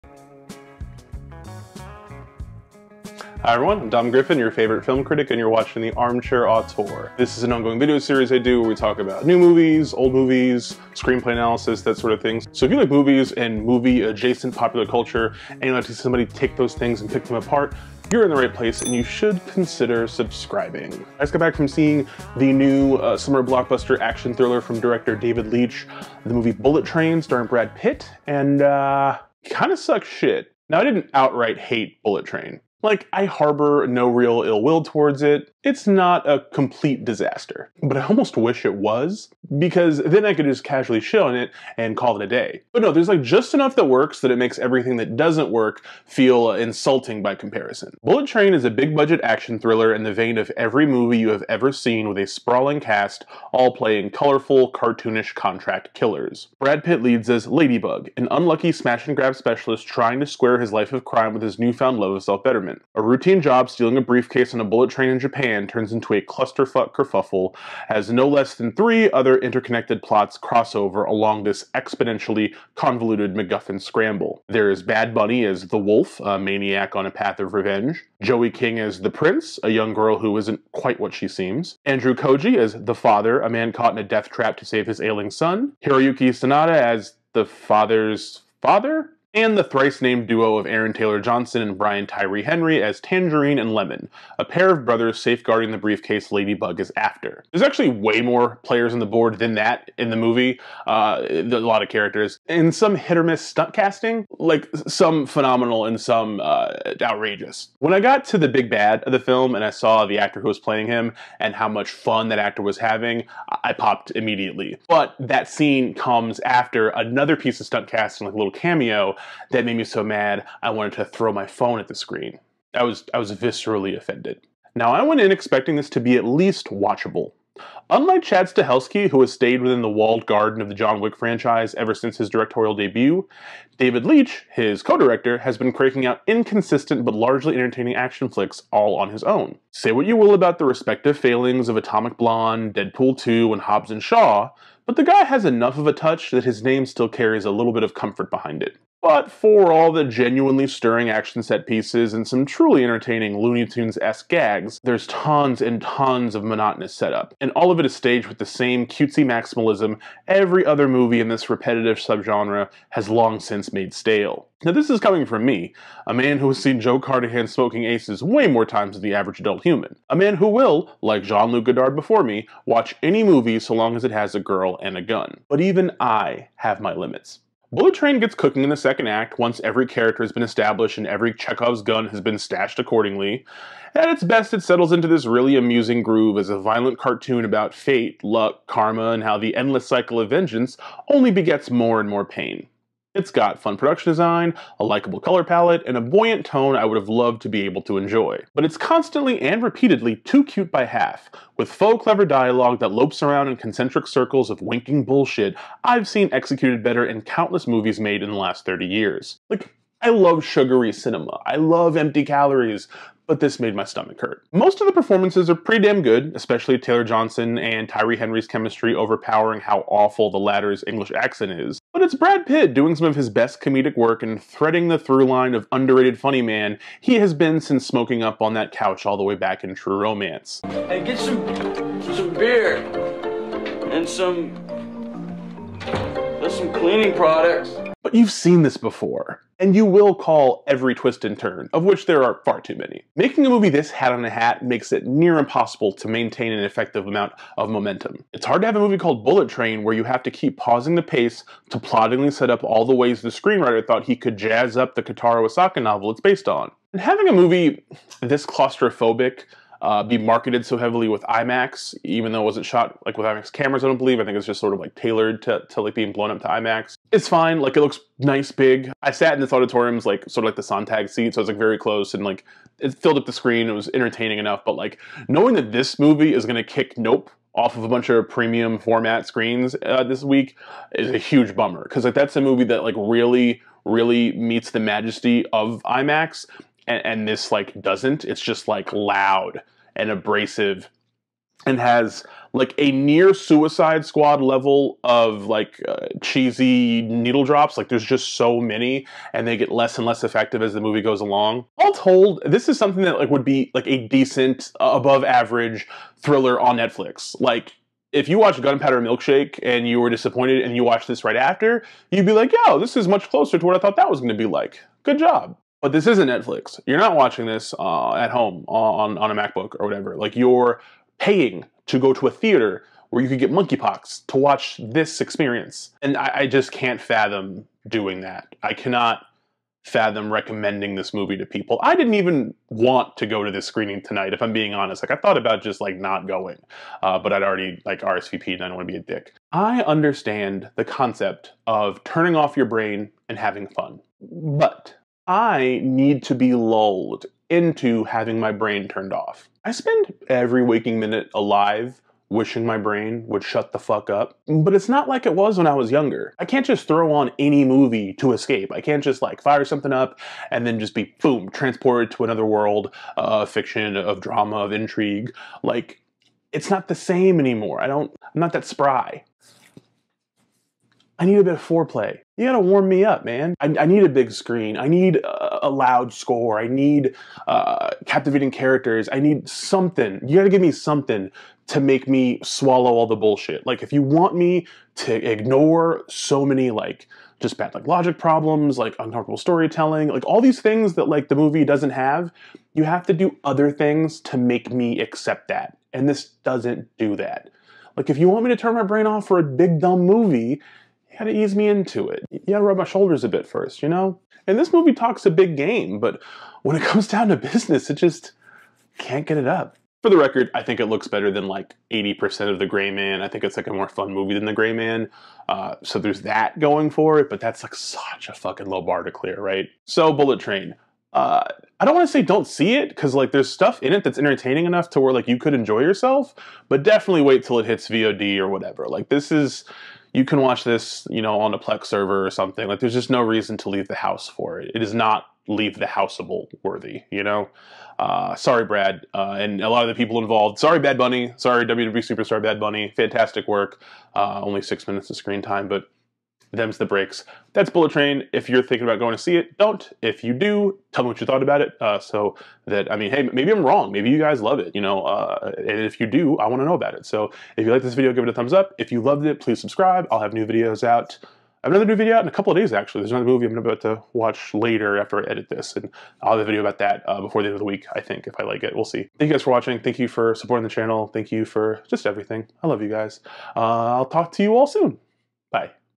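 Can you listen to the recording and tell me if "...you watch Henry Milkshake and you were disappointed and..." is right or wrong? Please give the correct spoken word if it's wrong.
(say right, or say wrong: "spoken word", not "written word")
wrong: "Gunpowder", not "Henry".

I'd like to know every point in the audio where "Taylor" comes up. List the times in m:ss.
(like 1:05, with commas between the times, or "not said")
1:30, 3:36.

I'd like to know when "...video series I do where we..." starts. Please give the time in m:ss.
0:07.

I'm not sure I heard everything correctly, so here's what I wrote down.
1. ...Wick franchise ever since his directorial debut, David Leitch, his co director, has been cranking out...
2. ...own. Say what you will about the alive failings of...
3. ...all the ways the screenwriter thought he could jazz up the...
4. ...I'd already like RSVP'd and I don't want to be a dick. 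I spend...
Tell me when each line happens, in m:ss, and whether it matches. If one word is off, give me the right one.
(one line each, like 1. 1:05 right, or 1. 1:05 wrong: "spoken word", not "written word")
1. 2:11 right
2. 2:19 wrong: "respective", not "alive"
3. 4:12 right
4. 5:37 wrong: "understand", not "spend".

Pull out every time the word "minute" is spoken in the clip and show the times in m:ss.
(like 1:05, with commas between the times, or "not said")
5:50, 7:24.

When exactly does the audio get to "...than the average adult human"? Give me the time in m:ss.
2:48.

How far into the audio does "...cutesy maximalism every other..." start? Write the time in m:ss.
2:38.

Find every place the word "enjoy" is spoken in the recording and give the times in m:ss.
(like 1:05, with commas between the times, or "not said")
3:17, 7:05.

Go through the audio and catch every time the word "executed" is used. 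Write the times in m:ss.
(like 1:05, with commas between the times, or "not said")
3:26.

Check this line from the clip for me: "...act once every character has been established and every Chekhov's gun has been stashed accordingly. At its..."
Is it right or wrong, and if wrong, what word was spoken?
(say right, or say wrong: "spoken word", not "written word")
right.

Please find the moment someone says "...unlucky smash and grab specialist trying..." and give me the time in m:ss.
0:58.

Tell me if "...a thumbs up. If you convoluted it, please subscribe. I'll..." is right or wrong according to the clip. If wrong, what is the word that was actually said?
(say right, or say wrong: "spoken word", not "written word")
wrong: "loved", not "convoluted".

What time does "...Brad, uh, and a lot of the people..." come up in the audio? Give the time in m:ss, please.
7:18.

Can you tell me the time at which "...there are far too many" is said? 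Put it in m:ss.
4:02.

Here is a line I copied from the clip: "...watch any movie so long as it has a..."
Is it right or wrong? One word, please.
right.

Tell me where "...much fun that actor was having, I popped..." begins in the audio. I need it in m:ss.
1:51.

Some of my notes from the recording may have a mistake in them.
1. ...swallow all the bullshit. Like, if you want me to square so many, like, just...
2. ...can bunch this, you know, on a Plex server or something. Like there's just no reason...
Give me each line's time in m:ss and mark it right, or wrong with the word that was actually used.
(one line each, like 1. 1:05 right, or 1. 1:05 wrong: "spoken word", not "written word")
1. 6:22 wrong: "ignore", not "square"
2. 7:10 wrong: "watch", not "bunch".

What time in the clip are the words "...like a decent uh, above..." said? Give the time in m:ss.
5:03.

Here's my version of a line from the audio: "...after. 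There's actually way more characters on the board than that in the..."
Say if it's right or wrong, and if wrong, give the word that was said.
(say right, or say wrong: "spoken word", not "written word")
wrong: "players", not "characters".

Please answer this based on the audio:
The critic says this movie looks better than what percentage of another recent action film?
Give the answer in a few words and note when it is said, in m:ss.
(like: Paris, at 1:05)
80%, at 6:51.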